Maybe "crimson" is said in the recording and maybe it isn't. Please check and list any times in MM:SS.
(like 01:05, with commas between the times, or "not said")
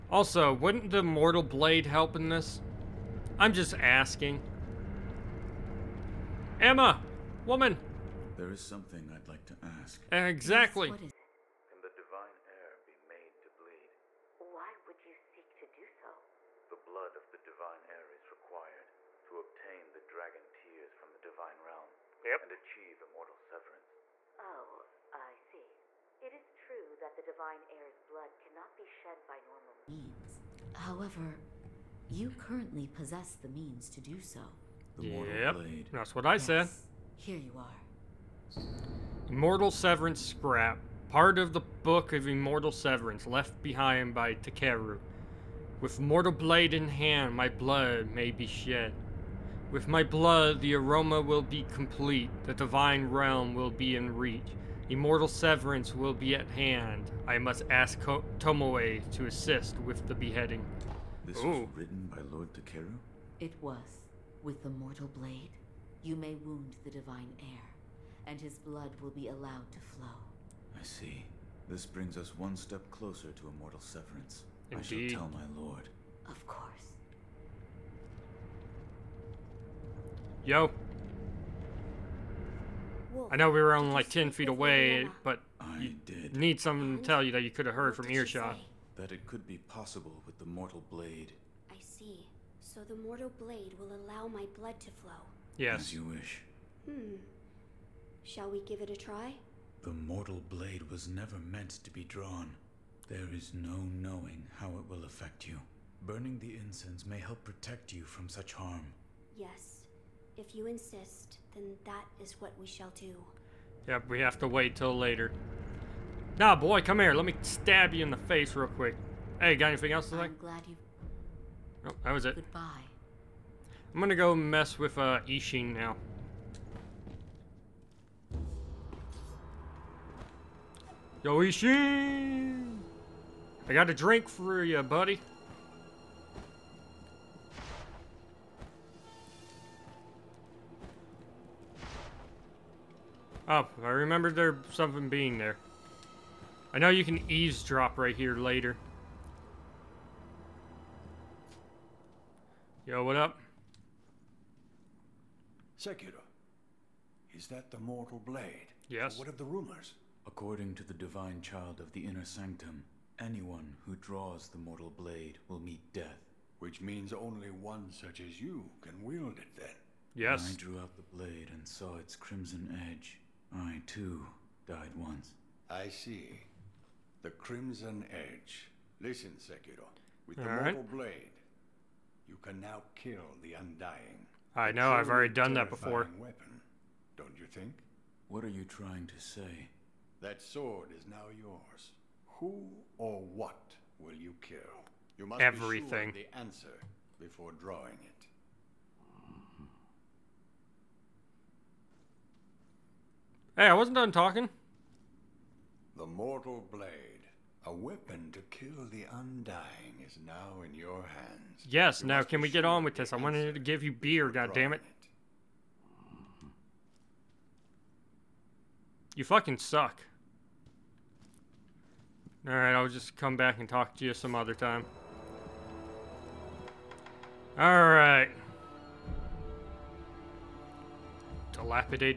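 02:52, 02:57.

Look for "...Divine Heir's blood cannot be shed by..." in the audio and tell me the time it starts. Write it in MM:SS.
00:27.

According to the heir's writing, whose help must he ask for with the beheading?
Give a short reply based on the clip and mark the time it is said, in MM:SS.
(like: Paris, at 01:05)
Tomoe, at 00:58.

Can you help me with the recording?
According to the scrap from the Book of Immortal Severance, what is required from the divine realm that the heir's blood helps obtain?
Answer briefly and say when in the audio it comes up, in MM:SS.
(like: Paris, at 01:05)
dragon tears, at 00:20.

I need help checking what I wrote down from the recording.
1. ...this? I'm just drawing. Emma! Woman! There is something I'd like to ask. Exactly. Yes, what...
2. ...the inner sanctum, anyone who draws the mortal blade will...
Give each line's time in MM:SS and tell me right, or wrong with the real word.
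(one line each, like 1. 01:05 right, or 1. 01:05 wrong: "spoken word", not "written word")
1. 00:02 wrong: "asking", not "drawing"
2. 02:41 right.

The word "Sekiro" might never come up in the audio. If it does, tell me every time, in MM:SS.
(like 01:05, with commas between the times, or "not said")
02:35, 02:59.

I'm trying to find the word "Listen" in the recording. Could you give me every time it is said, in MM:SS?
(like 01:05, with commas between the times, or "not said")
02:59.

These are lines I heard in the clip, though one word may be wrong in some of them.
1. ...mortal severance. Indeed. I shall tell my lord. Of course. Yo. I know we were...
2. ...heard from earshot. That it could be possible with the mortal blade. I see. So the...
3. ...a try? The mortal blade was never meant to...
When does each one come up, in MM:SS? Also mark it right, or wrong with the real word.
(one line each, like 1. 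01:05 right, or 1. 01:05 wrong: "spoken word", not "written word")
1. 01:13 wrong: "immortal", not "mortal"
2. 01:27 right
3. 01:38 right.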